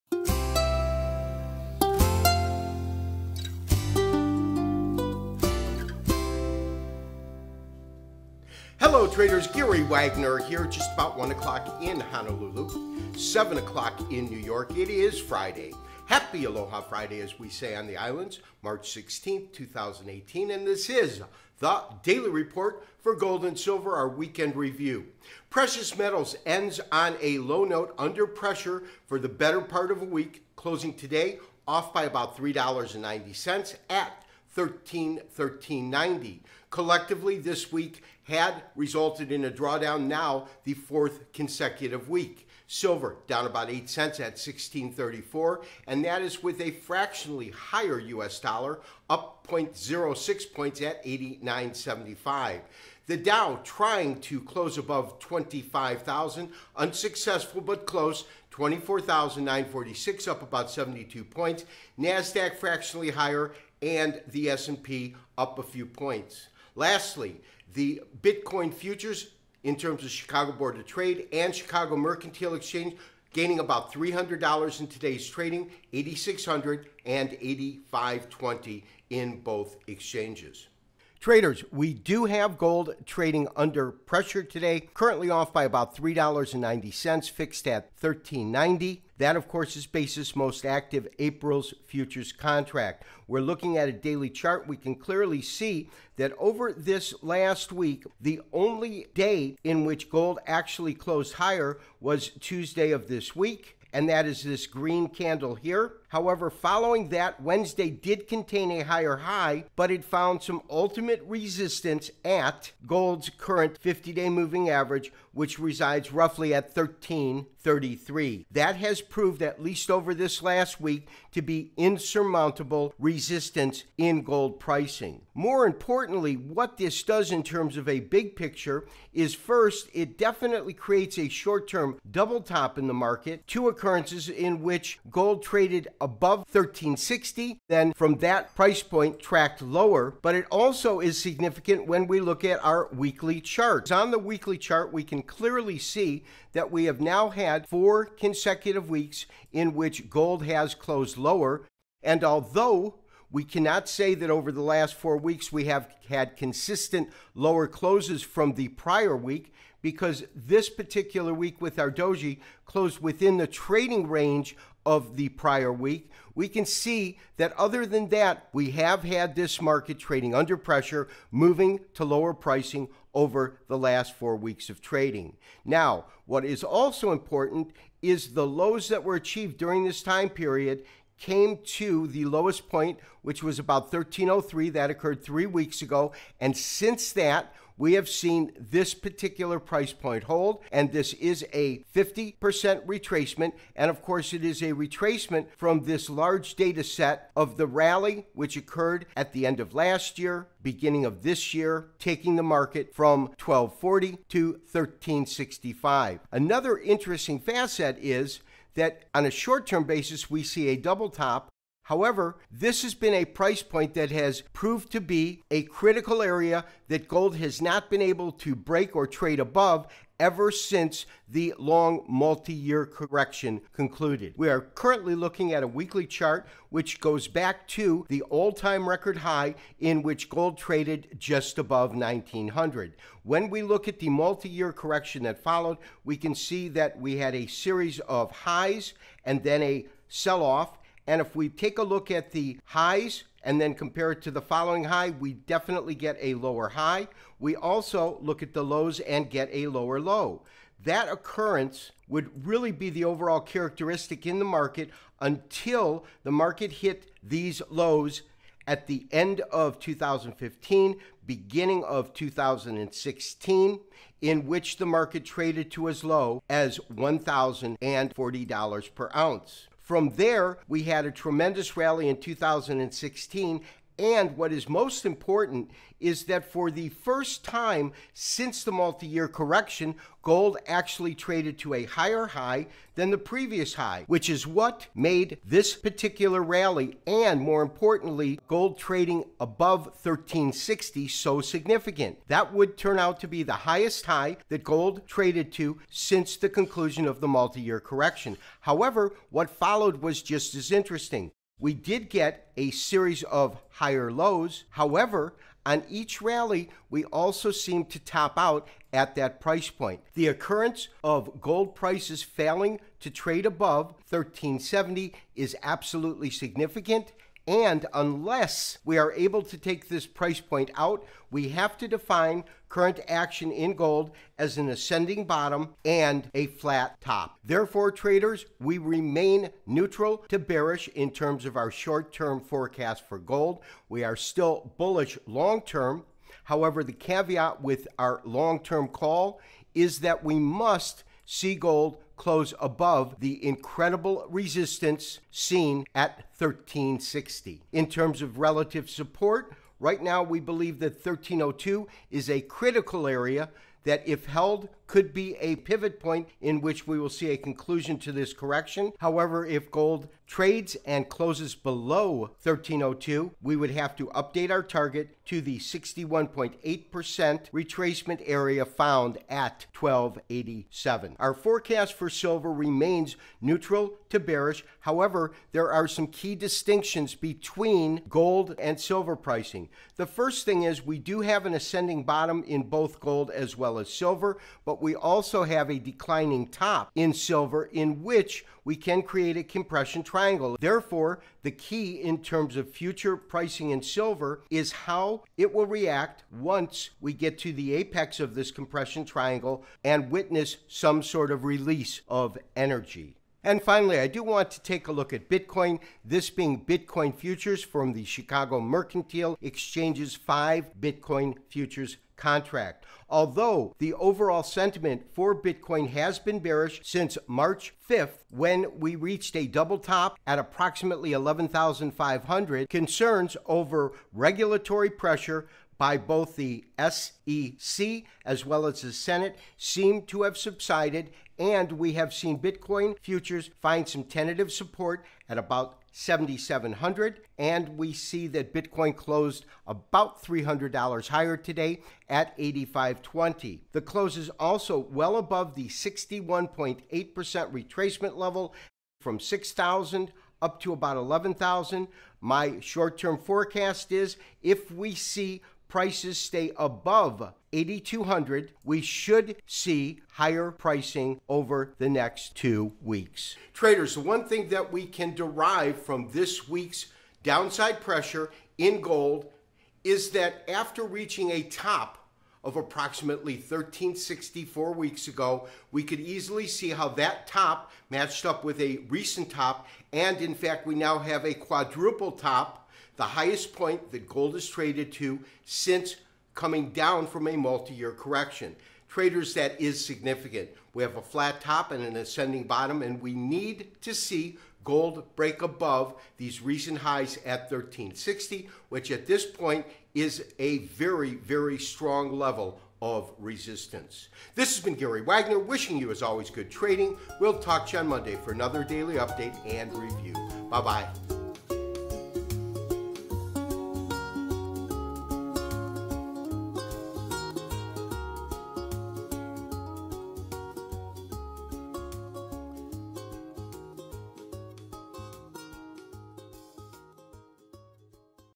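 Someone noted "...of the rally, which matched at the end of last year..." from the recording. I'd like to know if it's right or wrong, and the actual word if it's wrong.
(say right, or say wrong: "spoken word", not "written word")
wrong: "occurred", not "matched".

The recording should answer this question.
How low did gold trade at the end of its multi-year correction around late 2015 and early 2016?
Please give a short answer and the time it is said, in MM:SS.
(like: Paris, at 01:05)
$1,040, at 04:26.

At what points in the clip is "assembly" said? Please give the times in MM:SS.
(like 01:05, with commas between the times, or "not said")
not said.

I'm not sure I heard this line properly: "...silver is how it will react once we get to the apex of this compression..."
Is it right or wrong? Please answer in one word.
right.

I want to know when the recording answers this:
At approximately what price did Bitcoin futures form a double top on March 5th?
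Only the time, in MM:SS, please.
07:01.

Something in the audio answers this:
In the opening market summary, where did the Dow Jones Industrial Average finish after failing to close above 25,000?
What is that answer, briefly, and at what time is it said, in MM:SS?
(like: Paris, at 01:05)
24,946, at 00:58.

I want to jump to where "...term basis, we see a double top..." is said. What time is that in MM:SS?
03:29.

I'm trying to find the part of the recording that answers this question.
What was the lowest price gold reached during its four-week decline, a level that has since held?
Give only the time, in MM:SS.
03:03.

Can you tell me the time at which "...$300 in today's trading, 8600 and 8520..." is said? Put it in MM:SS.
01:13.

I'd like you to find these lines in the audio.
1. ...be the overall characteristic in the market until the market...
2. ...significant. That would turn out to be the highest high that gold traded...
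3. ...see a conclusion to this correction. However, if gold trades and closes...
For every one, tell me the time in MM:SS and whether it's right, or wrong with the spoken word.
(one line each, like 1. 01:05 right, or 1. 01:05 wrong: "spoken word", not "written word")
1. 04:12 right
2. 04:51 right
3. 05:57 right.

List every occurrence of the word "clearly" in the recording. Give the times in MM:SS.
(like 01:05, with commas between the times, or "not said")
01:34, 02:25.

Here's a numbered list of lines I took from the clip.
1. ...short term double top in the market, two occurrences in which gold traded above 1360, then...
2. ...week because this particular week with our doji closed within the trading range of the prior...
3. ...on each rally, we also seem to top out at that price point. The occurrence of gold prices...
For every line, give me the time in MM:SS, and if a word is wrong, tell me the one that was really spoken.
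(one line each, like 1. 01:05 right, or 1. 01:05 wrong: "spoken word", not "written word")
1. 02:11 right
2. 02:39 right
3. 05:05 right.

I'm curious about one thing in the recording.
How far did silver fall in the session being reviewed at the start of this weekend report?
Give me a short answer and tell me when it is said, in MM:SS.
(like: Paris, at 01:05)
8 cents, at 00:43.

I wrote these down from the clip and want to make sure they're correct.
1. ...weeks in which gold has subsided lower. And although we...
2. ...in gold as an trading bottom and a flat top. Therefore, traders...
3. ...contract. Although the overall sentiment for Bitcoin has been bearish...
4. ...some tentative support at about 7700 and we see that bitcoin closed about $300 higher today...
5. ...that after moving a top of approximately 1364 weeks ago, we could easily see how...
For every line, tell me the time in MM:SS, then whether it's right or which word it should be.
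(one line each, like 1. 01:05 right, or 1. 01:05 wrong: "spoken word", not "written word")
1. 02:28 wrong: "closed", not "subsided"
2. 05:23 wrong: "ascending", not "trading"
3. 06:52 right
4. 07:13 right
5. 07:50 wrong: "reaching", not "moving".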